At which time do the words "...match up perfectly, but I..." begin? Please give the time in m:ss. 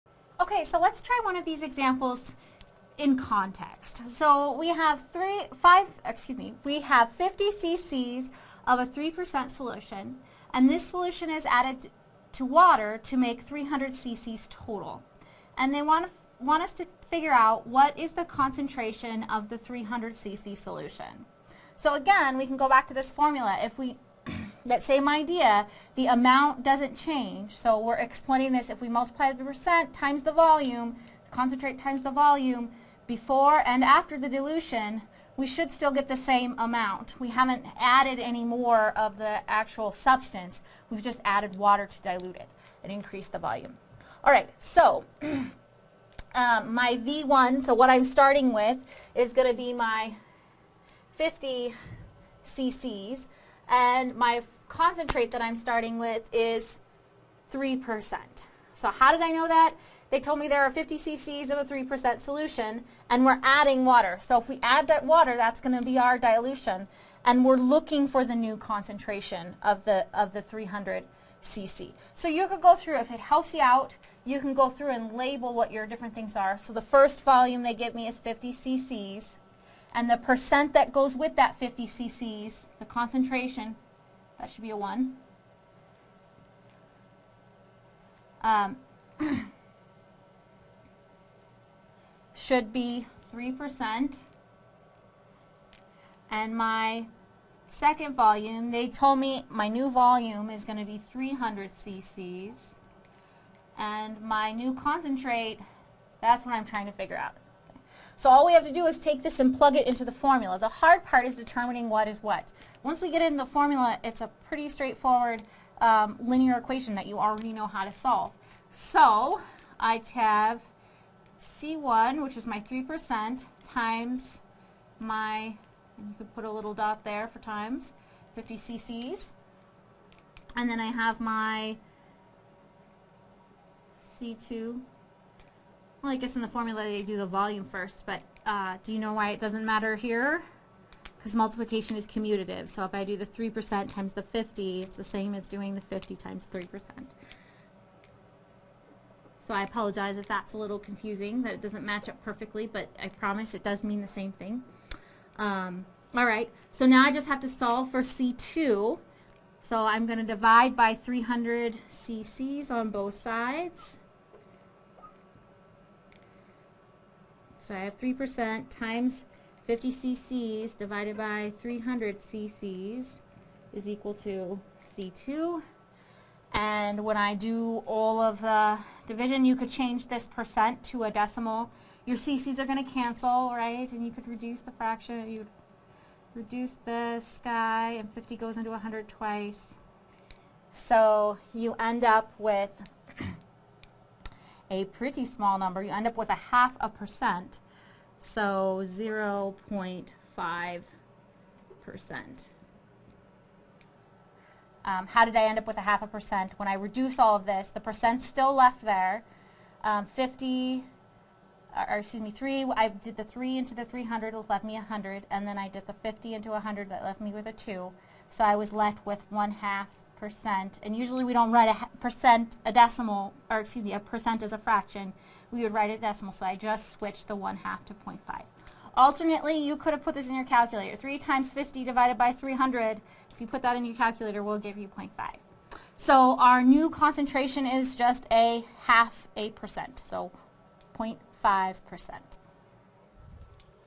2:31.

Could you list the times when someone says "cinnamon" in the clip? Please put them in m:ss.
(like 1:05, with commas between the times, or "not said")
not said.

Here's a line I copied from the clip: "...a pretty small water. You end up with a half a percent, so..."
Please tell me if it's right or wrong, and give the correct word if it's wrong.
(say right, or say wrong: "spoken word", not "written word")
wrong: "number", not "water".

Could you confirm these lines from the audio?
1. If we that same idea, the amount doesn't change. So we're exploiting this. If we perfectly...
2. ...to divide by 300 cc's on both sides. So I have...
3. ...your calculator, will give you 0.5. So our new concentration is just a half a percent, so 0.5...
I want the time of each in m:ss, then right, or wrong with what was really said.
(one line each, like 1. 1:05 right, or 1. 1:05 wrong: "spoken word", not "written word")
1. 0:23 wrong: "multiply", not "perfectly"
2. 2:40 right
3. 3:53 right.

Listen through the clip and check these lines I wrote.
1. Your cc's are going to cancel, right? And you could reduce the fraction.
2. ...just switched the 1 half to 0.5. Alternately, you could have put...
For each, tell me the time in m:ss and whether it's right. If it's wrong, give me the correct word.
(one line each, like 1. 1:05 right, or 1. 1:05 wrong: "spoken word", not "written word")
1. 3:02 right
2. 3:46 right.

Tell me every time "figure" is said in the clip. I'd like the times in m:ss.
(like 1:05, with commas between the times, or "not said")
0:17, 1:46.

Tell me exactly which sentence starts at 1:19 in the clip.
And the percent that goes with that 50 cc's, the concentration, that should be a 1.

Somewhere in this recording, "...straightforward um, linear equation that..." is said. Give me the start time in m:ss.
1:54.